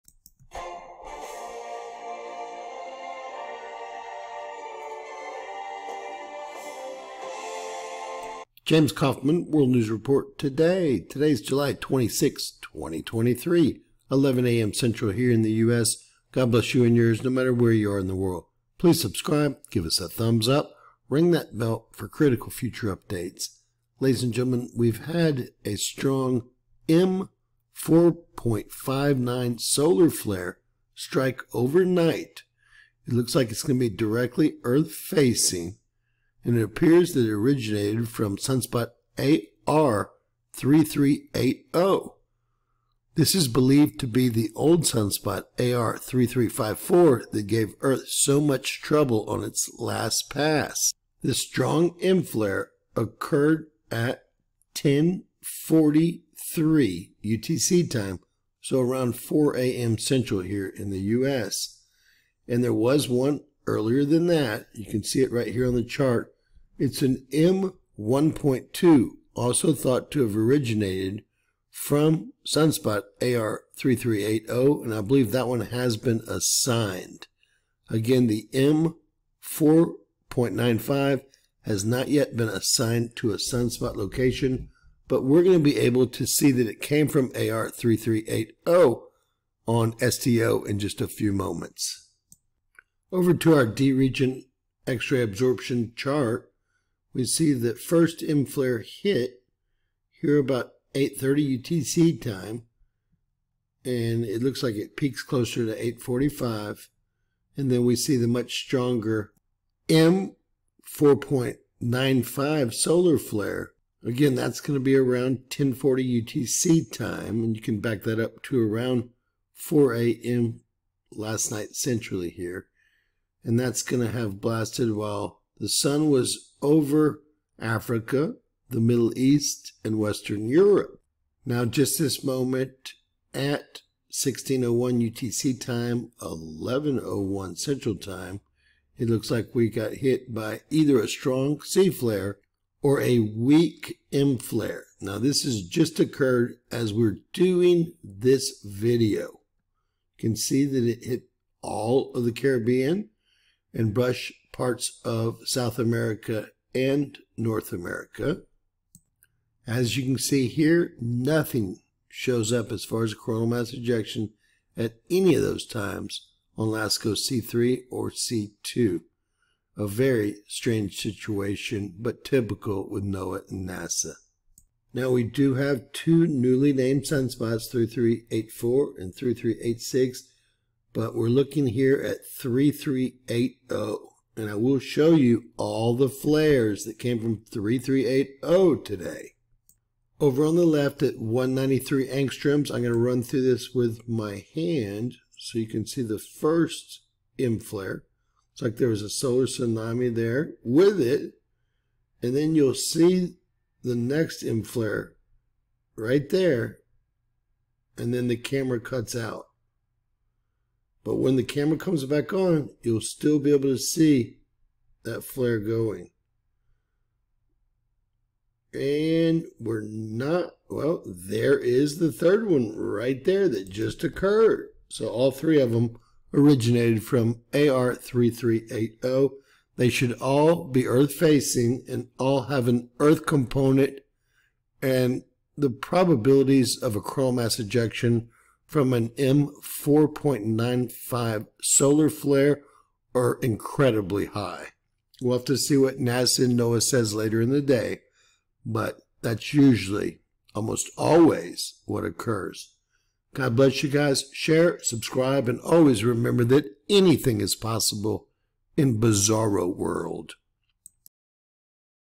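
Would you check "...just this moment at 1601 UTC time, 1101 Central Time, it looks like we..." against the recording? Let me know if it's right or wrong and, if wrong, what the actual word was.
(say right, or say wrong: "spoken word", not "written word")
right.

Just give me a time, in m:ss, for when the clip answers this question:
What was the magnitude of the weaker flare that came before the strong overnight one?
1:07.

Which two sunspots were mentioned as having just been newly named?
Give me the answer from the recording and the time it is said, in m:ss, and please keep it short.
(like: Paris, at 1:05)
3384 and 3386, at 2:57.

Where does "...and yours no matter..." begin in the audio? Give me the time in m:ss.
0:16.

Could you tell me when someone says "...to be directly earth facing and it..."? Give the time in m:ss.
0:33.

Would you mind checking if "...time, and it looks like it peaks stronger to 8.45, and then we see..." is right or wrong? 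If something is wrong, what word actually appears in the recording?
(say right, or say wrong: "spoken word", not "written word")
wrong: "closer", not "stronger".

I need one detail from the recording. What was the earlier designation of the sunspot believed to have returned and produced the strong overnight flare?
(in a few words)
AR3354.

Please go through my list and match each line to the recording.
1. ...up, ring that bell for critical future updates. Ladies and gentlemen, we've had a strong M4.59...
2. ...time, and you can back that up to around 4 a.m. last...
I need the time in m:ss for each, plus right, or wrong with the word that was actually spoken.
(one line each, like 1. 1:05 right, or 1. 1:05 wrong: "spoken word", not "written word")
1. 0:20 right
2. 1:56 right.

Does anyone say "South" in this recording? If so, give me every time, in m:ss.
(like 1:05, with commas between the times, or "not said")
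2:35.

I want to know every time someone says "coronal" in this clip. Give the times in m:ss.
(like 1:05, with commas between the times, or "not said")
2:43, 3:57.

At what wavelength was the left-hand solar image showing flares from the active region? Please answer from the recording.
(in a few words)
193 angstroms.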